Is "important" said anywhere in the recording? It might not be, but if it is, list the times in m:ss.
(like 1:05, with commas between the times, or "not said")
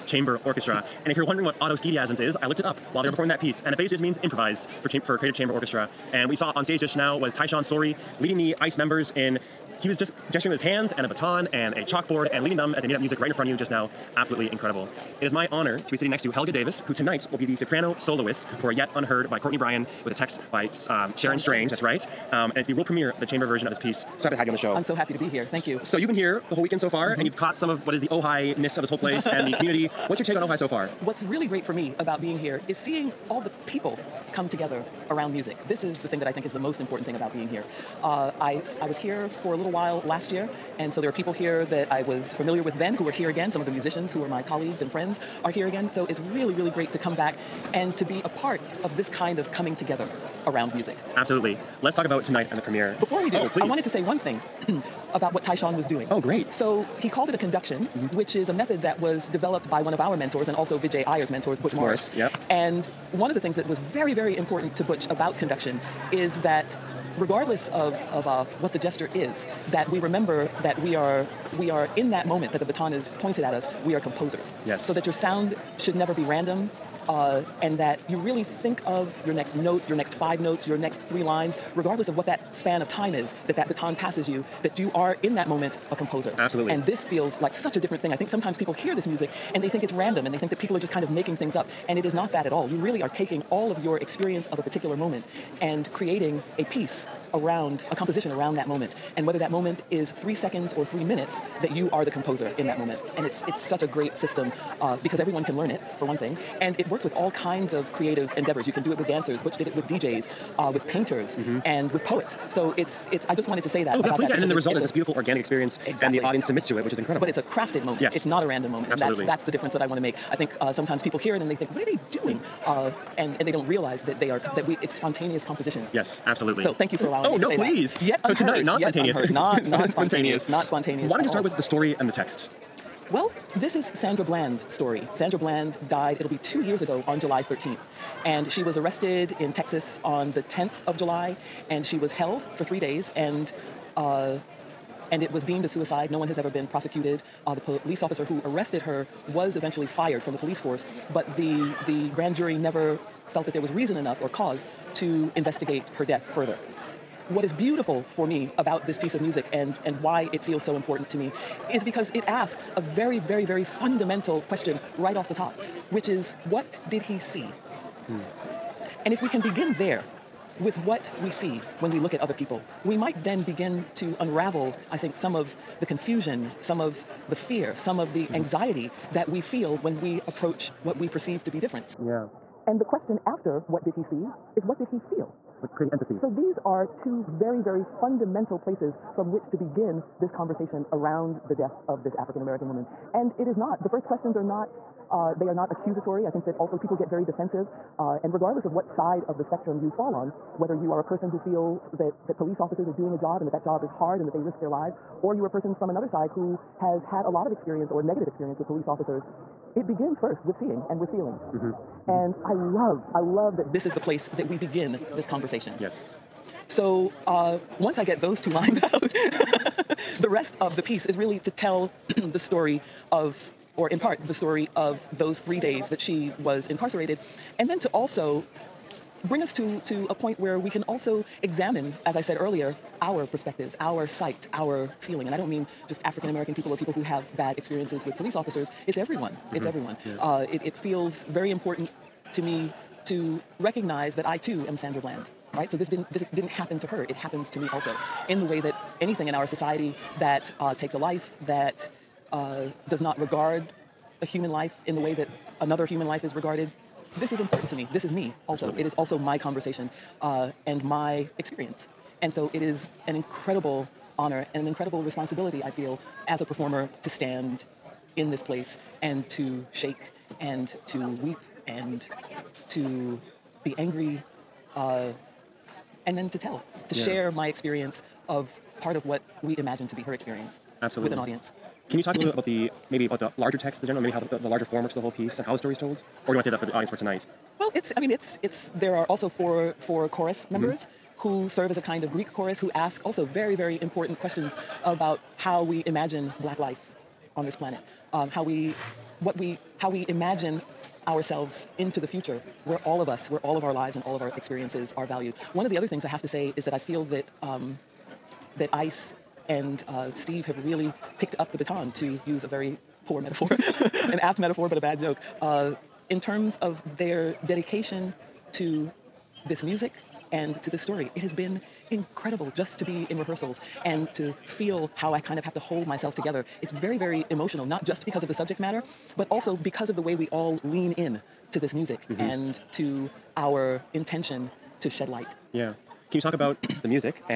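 0:36, 1:04, 2:40, 4:01, 4:17, 4:53.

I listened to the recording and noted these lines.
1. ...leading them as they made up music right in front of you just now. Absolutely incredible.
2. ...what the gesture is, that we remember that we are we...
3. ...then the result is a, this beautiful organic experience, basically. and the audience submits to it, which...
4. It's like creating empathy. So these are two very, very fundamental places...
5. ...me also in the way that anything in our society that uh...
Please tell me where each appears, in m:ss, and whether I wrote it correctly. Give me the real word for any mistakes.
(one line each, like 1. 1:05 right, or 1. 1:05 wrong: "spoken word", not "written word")
1. 0:12 right
2. 1:08 right
3. 1:54 wrong: "exactly", not "basically"
4. 3:05 right
5. 4:07 right.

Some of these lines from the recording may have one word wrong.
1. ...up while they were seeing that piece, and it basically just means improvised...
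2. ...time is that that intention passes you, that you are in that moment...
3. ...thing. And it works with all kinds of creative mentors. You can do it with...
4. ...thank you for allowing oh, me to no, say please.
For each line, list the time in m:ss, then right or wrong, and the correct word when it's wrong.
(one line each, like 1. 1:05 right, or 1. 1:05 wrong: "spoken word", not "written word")
1. 0:02 wrong: "performing", not "seeing"
2. 1:22 wrong: "baton", not "intention"
3. 1:46 wrong: "endeavors", not "mentors"
4. 2:06 right.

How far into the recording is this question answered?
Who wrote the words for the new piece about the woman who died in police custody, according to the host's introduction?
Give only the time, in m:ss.
0:21.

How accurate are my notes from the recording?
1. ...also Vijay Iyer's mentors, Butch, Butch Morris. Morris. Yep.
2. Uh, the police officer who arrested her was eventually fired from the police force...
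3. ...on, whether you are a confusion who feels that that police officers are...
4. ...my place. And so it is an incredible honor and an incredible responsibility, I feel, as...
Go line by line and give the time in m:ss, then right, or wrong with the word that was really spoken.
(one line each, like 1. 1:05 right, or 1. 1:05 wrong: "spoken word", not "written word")
1. 1:00 right
2. 2:27 right
3. 3:20 wrong: "person", not "confusion"
4. 4:20 wrong: "experience", not "place".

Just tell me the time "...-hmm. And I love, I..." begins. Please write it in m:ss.
3:31.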